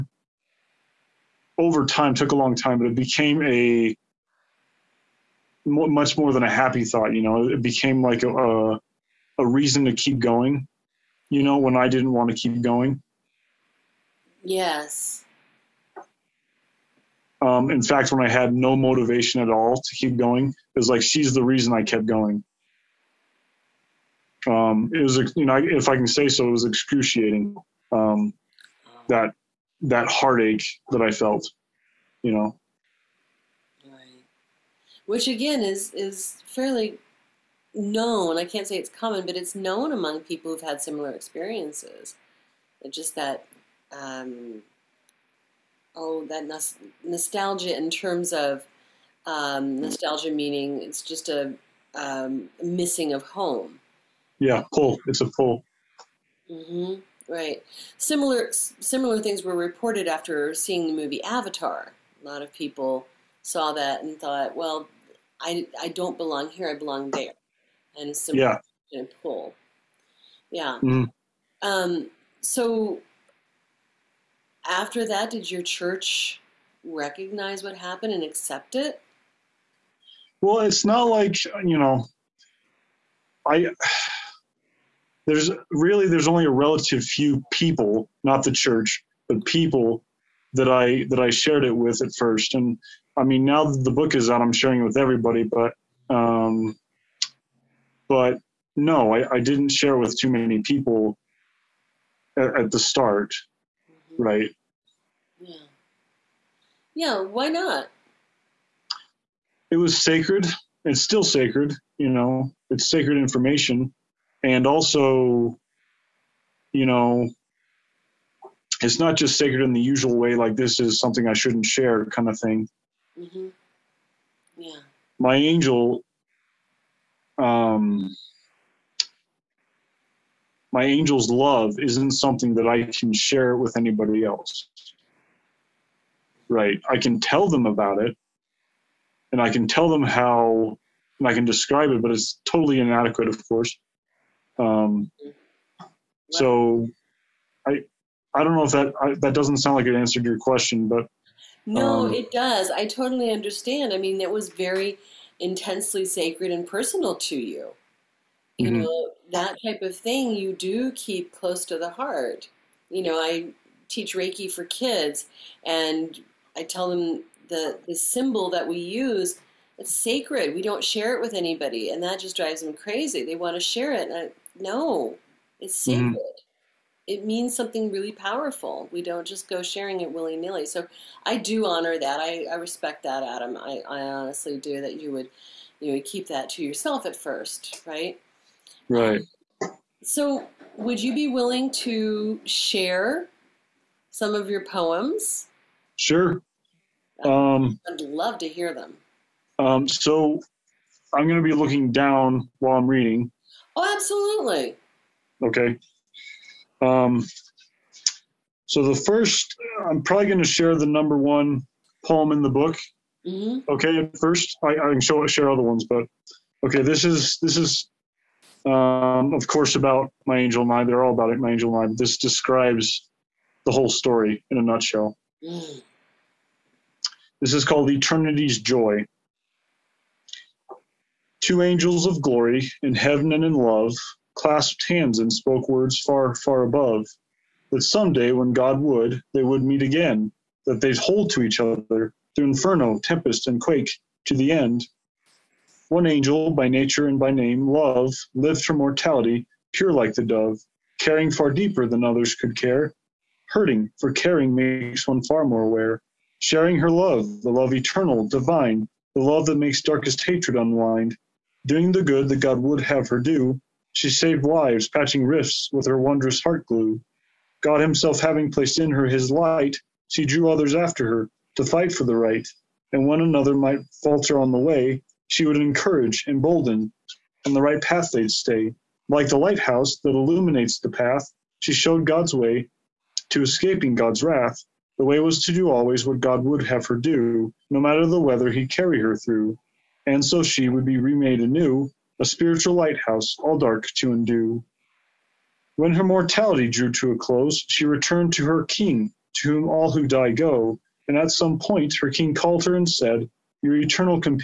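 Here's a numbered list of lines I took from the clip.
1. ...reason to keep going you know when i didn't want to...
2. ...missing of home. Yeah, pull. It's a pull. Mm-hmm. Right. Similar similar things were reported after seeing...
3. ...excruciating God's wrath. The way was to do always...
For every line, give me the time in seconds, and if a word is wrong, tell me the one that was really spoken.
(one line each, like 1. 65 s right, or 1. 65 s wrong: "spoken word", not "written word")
1. 9 s right
2. 52 s right
3. 283 s wrong: "escaping", not "excruciating".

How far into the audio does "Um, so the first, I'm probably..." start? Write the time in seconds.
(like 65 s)
206 s.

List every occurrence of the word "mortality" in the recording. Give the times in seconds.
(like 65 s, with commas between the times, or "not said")
248 s, 296 s.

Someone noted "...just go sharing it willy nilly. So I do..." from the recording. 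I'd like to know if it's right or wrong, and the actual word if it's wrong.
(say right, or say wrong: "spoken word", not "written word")
right.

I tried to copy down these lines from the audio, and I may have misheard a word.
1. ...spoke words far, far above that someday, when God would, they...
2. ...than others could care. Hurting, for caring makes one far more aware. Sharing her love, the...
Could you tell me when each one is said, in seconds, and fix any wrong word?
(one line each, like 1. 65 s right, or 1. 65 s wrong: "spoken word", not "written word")
1. 235 s right
2. 251 s right.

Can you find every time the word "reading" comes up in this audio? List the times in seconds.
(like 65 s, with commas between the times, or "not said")
202 s.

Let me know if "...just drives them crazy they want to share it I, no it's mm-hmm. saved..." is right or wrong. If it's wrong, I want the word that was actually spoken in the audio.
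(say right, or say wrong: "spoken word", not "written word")
wrong: "sacred", not "saved".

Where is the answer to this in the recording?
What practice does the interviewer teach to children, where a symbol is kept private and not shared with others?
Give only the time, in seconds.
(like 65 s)
164 s.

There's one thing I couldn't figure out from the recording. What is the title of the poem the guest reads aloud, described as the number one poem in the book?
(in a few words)
Eternity's Joy.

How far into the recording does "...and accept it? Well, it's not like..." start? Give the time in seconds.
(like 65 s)
78 s.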